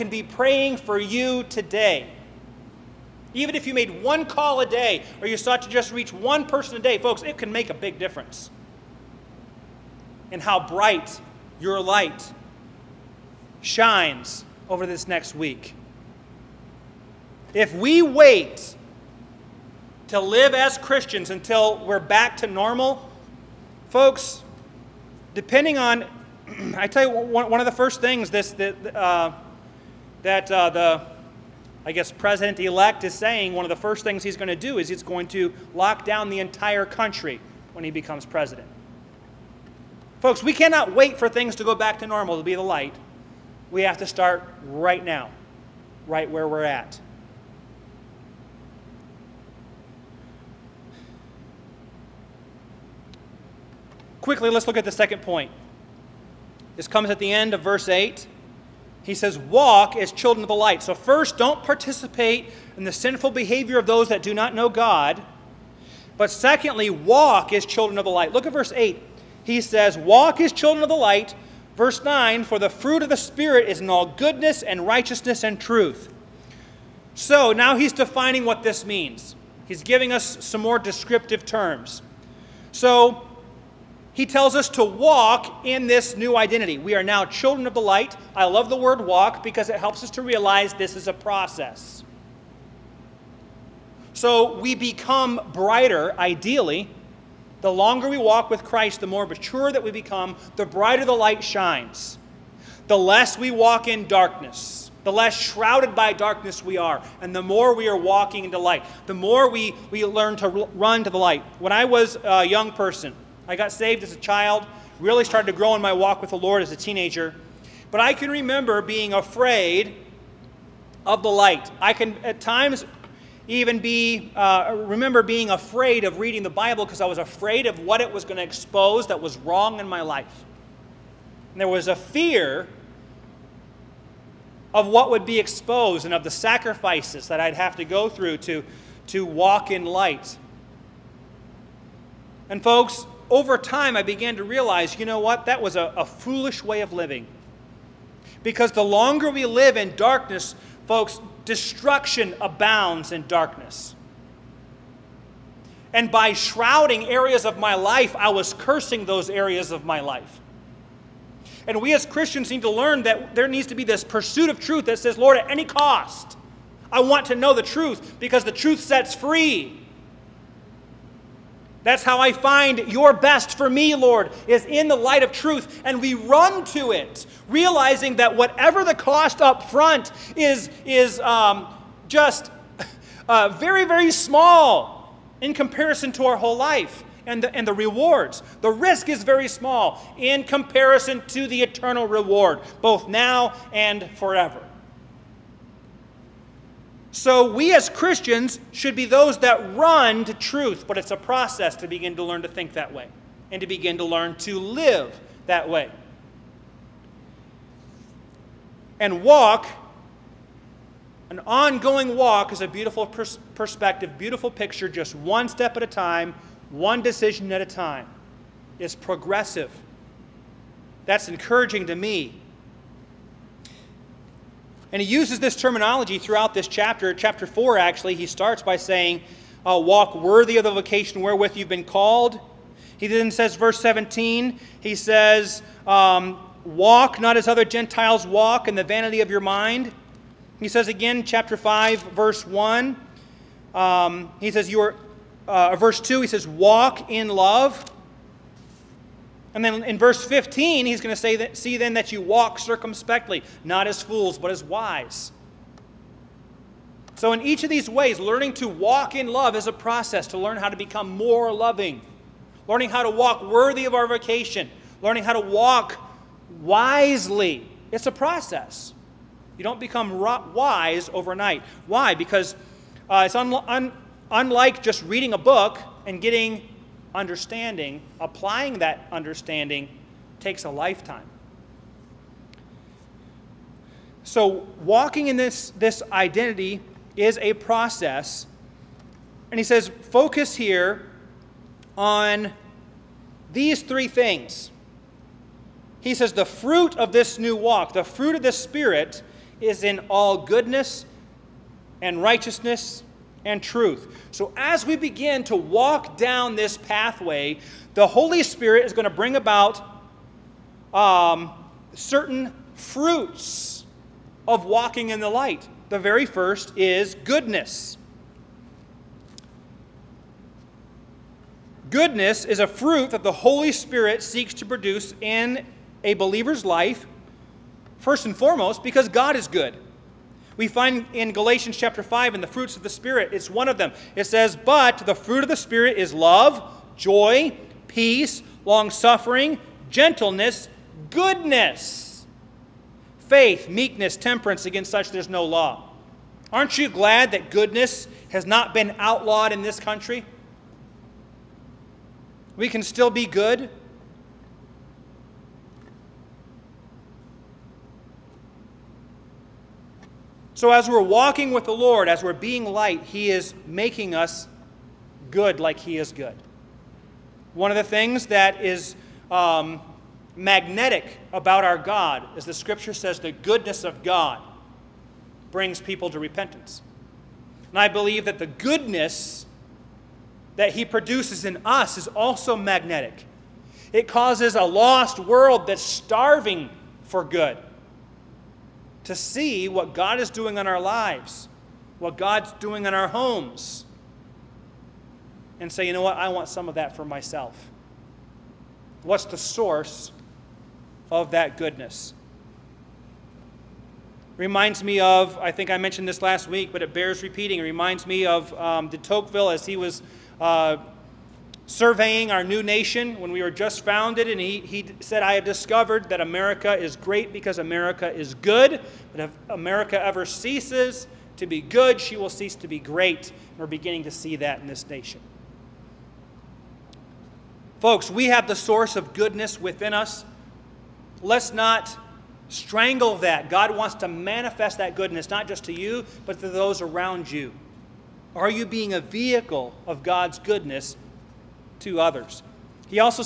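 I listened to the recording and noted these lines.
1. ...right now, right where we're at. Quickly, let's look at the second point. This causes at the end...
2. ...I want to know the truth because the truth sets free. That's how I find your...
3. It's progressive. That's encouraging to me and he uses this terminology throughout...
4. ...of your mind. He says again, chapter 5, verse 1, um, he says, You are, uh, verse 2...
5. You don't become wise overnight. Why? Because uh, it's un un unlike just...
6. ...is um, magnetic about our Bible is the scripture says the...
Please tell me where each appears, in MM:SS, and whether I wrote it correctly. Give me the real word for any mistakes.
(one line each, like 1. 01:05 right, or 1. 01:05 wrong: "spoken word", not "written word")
1. 00:44 wrong: "comes", not "causes"
2. 02:46 right
3. 03:38 right
4. 03:59 right
5. 04:29 right
6. 06:08 wrong: "God", not "Bible".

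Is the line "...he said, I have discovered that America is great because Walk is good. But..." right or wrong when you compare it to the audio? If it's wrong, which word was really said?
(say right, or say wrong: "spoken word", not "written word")
wrong: "America", not "Walk".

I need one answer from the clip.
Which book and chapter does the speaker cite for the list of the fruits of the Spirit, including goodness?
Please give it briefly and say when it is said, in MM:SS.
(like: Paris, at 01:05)
Galatians chapter 5, at 05:31.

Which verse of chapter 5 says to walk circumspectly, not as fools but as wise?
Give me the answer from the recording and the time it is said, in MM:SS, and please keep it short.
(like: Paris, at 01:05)
verse 15, at 04:09.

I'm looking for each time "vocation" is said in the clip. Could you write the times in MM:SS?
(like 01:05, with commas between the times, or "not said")
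03:50, 04:24.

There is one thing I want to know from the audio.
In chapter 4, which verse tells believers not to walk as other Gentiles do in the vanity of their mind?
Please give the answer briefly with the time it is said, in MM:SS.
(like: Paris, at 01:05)
verse 17, at 03:53.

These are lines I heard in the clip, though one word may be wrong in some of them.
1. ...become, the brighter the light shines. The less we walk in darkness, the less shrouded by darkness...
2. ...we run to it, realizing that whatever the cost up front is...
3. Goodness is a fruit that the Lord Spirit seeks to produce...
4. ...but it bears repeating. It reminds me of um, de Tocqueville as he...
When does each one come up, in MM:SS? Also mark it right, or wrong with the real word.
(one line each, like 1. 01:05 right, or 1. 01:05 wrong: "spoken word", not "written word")
1. 01:39 right
2. 02:55 right
3. 05:21 wrong: "Holy", not "Lord"
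4. 06:46 right.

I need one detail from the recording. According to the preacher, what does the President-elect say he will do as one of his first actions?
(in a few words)
lock down the entire country.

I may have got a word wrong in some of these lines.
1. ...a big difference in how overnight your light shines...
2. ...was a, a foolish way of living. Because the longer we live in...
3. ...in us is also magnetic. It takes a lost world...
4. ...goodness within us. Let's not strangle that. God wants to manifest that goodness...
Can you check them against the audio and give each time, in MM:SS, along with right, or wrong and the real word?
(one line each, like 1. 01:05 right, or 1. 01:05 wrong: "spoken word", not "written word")
1. 00:07 wrong: "bright", not "overnight"
2. 02:25 right
3. 06:21 wrong: "causes", not "takes"
4. 07:09 right.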